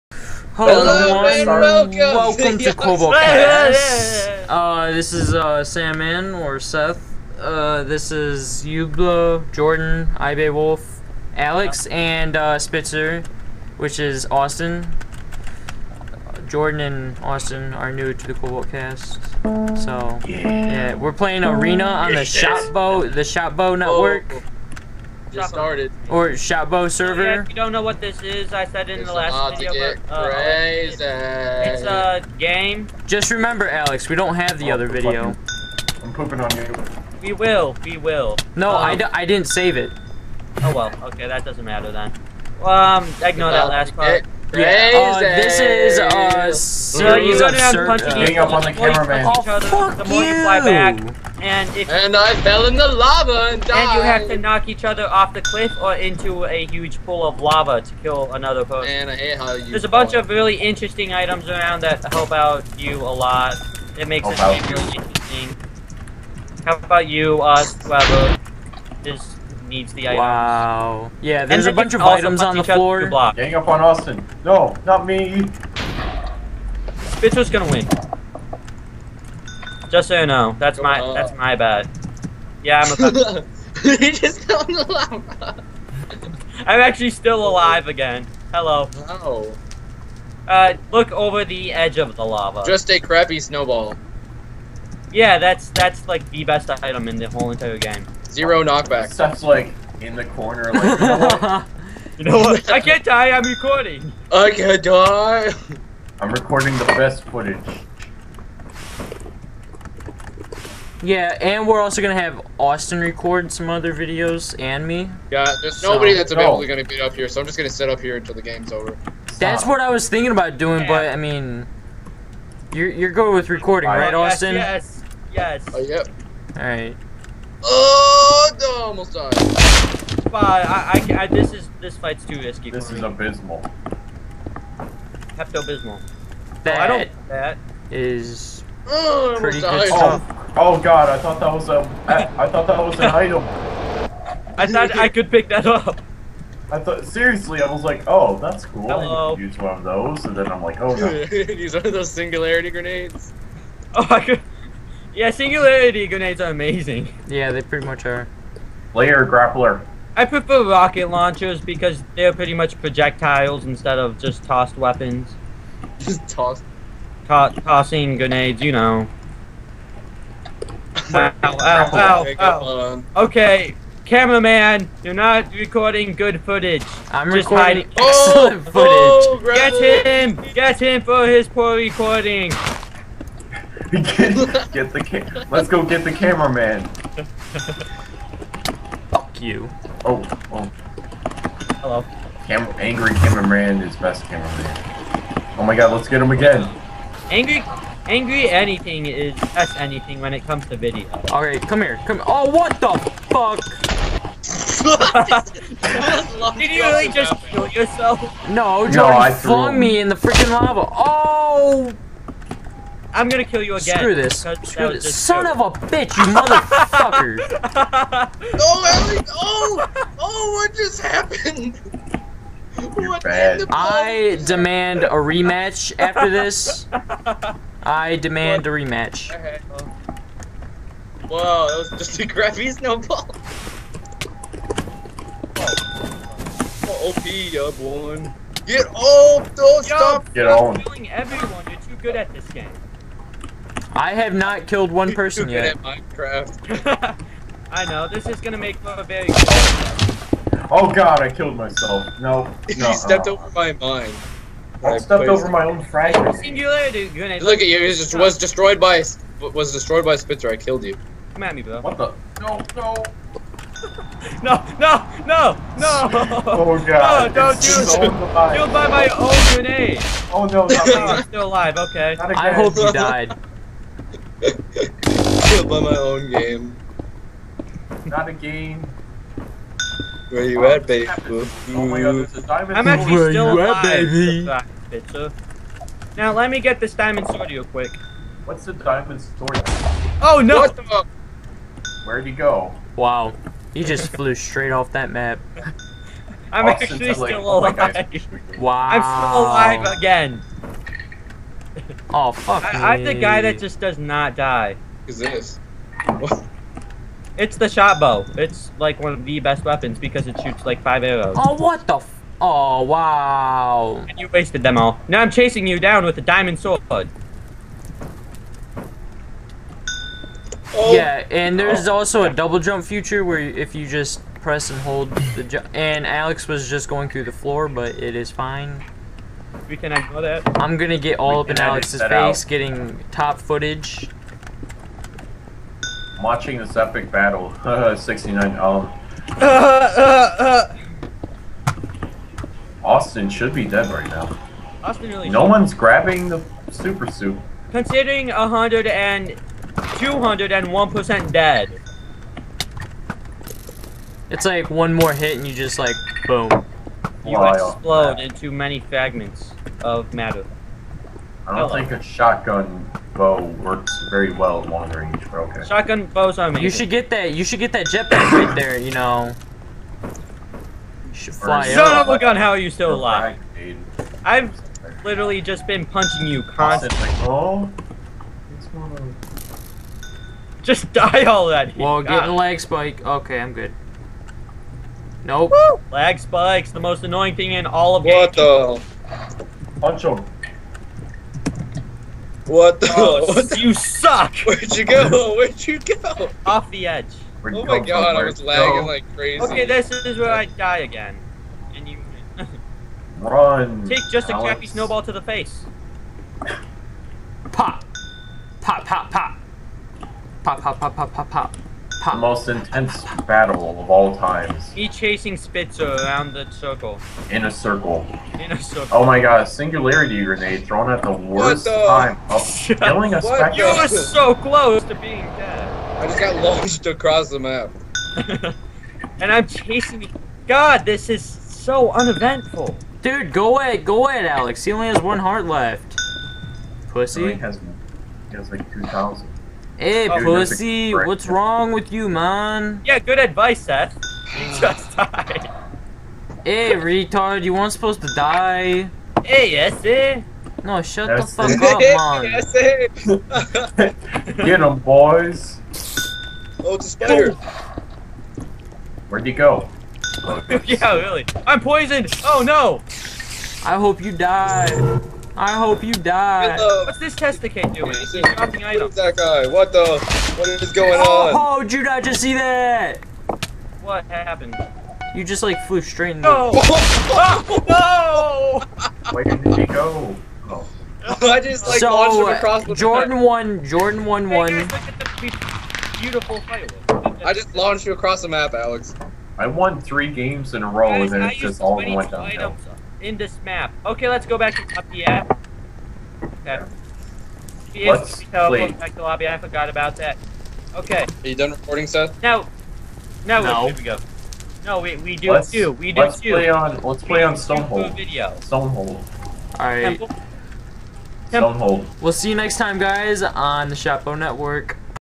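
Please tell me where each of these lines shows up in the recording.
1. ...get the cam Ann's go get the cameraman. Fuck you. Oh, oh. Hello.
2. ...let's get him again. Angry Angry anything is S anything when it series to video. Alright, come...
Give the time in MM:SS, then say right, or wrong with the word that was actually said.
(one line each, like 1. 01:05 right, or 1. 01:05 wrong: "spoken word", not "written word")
1. 03:04 wrong: "Let", not "Ann"
2. 03:15 wrong: "comes", not "series".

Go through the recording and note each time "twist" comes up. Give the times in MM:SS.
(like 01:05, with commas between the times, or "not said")
not said.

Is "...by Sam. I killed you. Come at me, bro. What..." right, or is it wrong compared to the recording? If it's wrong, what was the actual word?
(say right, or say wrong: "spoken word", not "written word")
wrong: "Spitzer", not "Sam".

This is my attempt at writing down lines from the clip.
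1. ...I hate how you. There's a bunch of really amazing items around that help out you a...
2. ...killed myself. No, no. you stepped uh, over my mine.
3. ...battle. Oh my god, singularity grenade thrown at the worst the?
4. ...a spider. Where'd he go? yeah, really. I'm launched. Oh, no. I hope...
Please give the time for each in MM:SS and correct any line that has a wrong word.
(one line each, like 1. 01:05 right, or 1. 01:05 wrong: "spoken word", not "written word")
1. 00:59 wrong: "interesting", not "amazing"
2. 04:11 right
3. 06:58 wrong: "circle", not "battle"
4. 07:36 wrong: "poisoned", not "launched".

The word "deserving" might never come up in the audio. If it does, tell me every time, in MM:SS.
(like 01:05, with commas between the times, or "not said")
not said.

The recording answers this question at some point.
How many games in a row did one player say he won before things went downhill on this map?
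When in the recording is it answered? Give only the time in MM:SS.
08:09.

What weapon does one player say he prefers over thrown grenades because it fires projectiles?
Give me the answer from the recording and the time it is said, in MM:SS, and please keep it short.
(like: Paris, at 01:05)
rocket launchers, at 02:40.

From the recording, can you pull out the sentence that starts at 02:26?
I thought seriously, I was like, oh, that's cool.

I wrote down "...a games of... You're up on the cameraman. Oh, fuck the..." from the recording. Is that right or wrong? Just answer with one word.
wrong.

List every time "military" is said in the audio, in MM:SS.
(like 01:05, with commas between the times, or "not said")
not said.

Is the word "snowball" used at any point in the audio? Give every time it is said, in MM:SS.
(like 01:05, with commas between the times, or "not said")
01:33, 03:52, 06:44.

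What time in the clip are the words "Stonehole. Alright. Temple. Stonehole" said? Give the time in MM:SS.
08:28.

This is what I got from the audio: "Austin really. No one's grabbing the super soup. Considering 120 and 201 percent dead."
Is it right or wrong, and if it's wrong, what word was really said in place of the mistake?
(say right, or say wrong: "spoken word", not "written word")
wrong: "100", not "120".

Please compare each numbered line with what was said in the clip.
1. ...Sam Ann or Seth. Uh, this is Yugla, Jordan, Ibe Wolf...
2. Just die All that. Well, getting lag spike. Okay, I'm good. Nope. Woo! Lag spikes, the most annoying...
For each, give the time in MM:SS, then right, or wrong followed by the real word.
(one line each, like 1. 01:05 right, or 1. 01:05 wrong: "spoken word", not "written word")
1. 00:05 right
2. 06:20 right.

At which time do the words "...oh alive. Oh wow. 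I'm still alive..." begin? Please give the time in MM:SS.
04:57.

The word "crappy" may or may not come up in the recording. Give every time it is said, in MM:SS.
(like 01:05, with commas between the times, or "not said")
01:33, 03:52, 06:44.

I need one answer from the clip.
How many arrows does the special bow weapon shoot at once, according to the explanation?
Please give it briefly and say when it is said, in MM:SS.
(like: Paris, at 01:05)
5, at 05:10.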